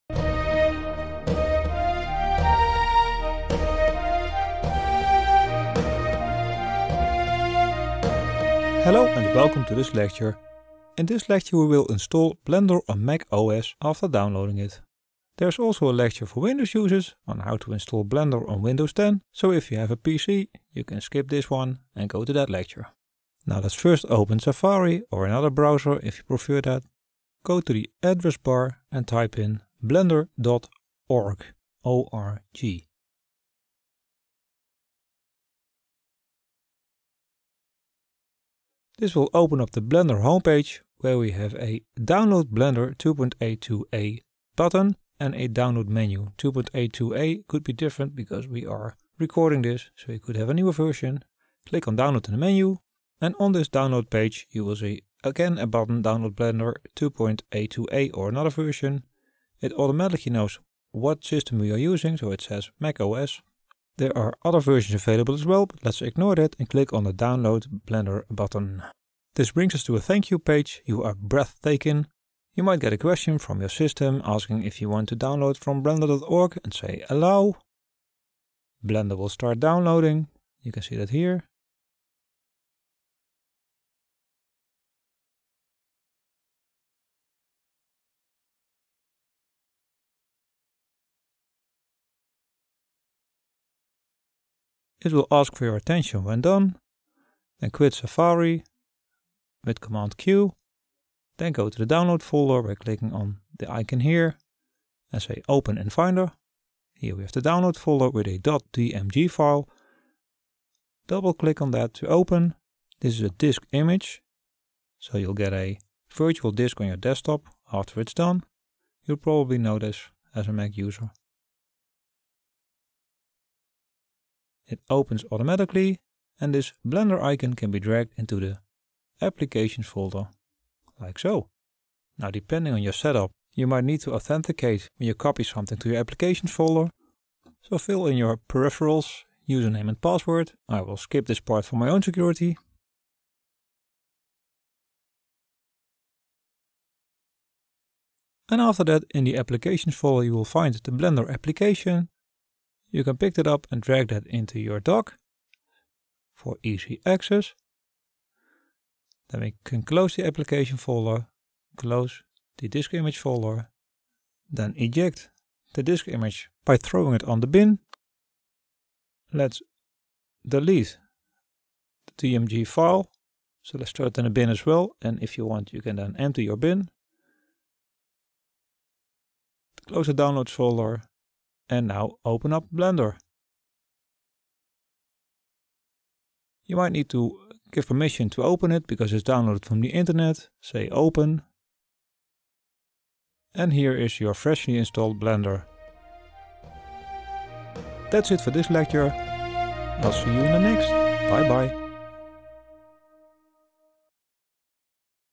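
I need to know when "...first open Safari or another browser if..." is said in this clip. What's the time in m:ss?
0:23.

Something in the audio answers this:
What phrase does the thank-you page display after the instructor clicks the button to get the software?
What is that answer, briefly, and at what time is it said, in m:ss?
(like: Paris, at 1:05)
you are breathtaking, at 1:10.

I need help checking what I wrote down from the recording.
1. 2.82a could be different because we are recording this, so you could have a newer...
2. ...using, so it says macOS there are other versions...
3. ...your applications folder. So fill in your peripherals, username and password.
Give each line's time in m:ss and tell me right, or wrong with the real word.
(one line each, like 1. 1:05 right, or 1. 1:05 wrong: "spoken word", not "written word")
1. 0:46 right
2. 1:01 right
3. 2:15 right.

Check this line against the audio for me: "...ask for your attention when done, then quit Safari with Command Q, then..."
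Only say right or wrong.
right.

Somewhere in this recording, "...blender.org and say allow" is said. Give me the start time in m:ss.
1:15.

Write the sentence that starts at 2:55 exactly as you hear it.
And if you want, you can then empty your bin.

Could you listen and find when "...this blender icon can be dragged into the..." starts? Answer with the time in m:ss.
2:06.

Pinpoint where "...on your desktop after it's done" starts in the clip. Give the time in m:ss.
1:56.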